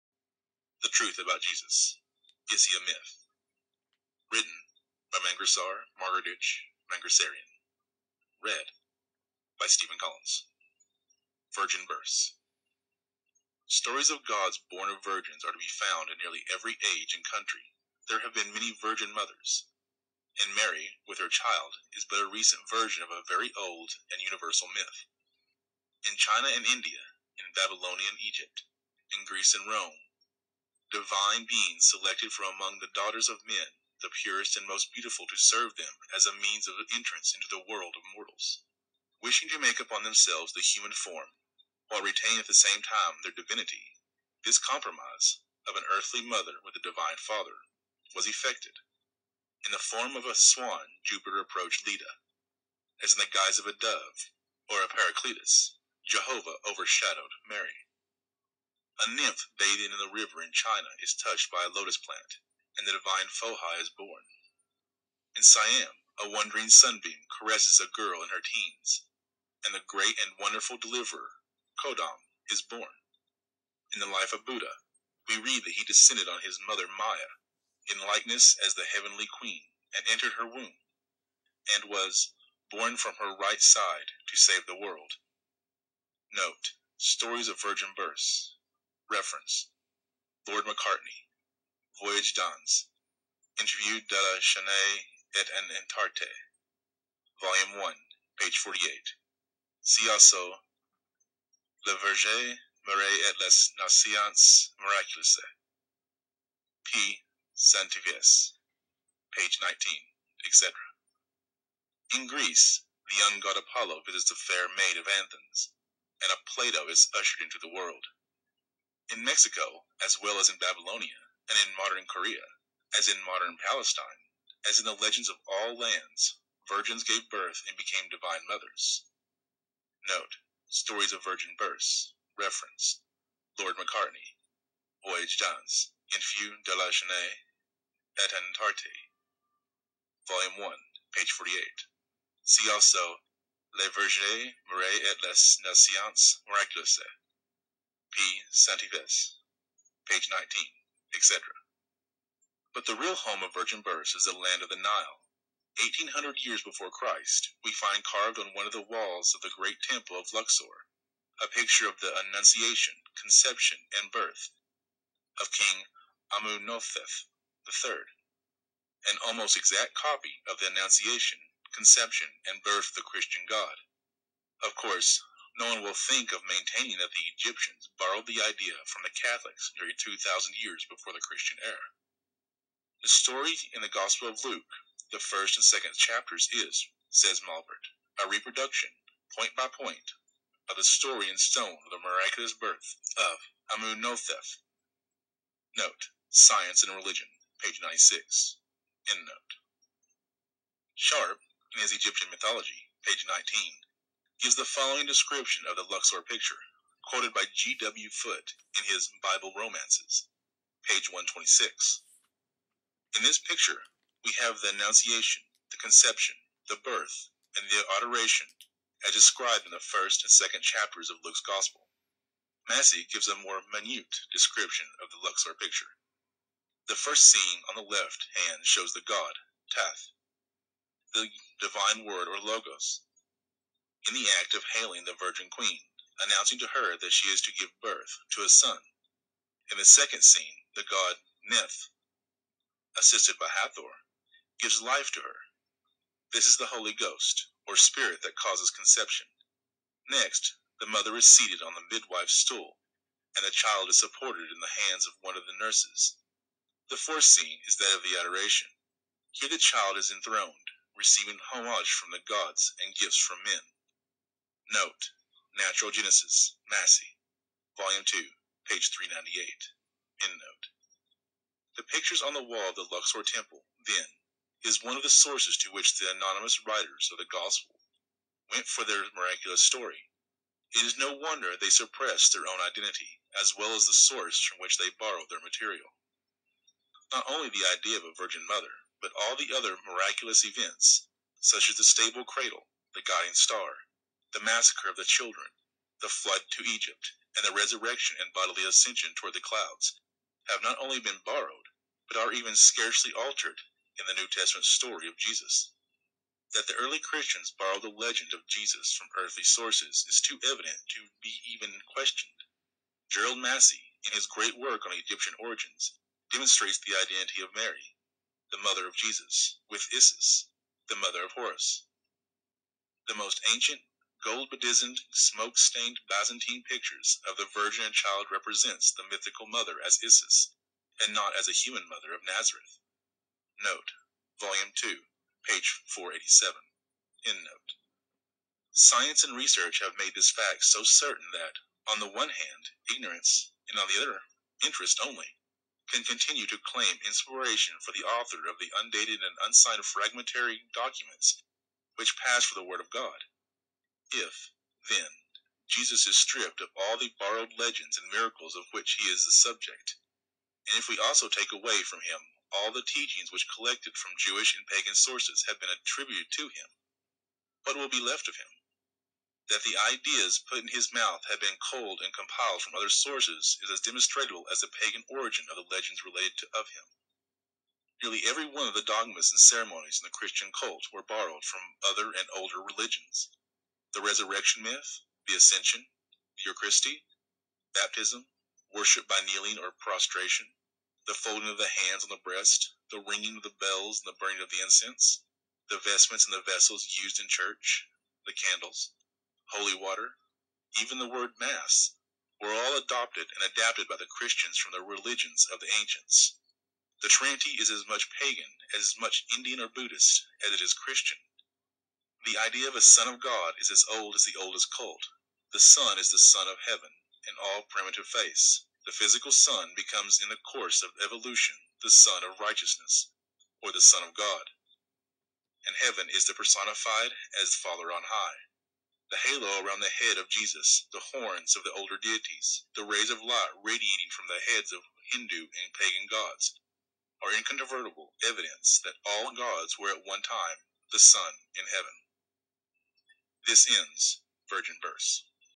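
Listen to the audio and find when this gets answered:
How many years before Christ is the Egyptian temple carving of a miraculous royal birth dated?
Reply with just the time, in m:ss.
2:35.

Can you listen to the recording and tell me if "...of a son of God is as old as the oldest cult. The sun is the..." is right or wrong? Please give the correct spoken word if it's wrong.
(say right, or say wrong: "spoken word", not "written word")
right.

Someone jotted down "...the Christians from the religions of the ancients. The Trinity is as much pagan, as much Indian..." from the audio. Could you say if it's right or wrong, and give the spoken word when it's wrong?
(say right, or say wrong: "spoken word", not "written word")
right.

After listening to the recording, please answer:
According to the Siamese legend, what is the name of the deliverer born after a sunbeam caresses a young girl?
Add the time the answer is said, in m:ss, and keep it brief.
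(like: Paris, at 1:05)
Kodam, at 1:11.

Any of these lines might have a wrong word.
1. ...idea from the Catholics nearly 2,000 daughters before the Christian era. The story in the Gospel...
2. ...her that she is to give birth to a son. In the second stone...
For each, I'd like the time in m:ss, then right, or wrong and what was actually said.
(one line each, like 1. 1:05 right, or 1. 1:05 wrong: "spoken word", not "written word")
1. 2:58 wrong: "years", not "daughters"
2. 3:56 wrong: "scene", not "stone".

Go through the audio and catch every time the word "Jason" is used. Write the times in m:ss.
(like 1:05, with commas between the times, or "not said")
not said.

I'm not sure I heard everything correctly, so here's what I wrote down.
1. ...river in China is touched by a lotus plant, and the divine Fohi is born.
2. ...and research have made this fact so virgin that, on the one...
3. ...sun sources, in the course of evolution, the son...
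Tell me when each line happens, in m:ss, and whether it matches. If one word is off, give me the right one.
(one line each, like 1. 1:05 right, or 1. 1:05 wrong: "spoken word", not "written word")
1. 1:00 right
2. 5:39 wrong: "certain", not "virgin"
3. 6:59 wrong: "becomes", not "sources".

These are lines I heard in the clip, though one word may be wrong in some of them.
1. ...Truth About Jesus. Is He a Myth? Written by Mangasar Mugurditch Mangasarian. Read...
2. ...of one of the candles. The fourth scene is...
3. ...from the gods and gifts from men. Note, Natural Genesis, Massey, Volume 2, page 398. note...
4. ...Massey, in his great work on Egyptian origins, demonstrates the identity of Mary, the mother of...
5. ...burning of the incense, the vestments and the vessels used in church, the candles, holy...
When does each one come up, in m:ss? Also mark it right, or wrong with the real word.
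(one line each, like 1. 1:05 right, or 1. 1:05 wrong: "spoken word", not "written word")
1. 0:00 right
2. 4:15 wrong: "nurses", not "candles"
3. 4:21 right
4. 5:13 right
5. 6:34 right.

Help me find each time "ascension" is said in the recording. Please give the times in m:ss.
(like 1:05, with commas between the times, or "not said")
4:58, 6:25.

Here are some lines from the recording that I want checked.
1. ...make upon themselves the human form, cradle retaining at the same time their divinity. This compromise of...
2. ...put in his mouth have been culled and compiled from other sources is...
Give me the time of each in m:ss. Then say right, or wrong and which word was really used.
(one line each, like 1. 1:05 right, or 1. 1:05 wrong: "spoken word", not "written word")
1. 0:39 wrong: "while", not "cradle"
2. 6:10 right.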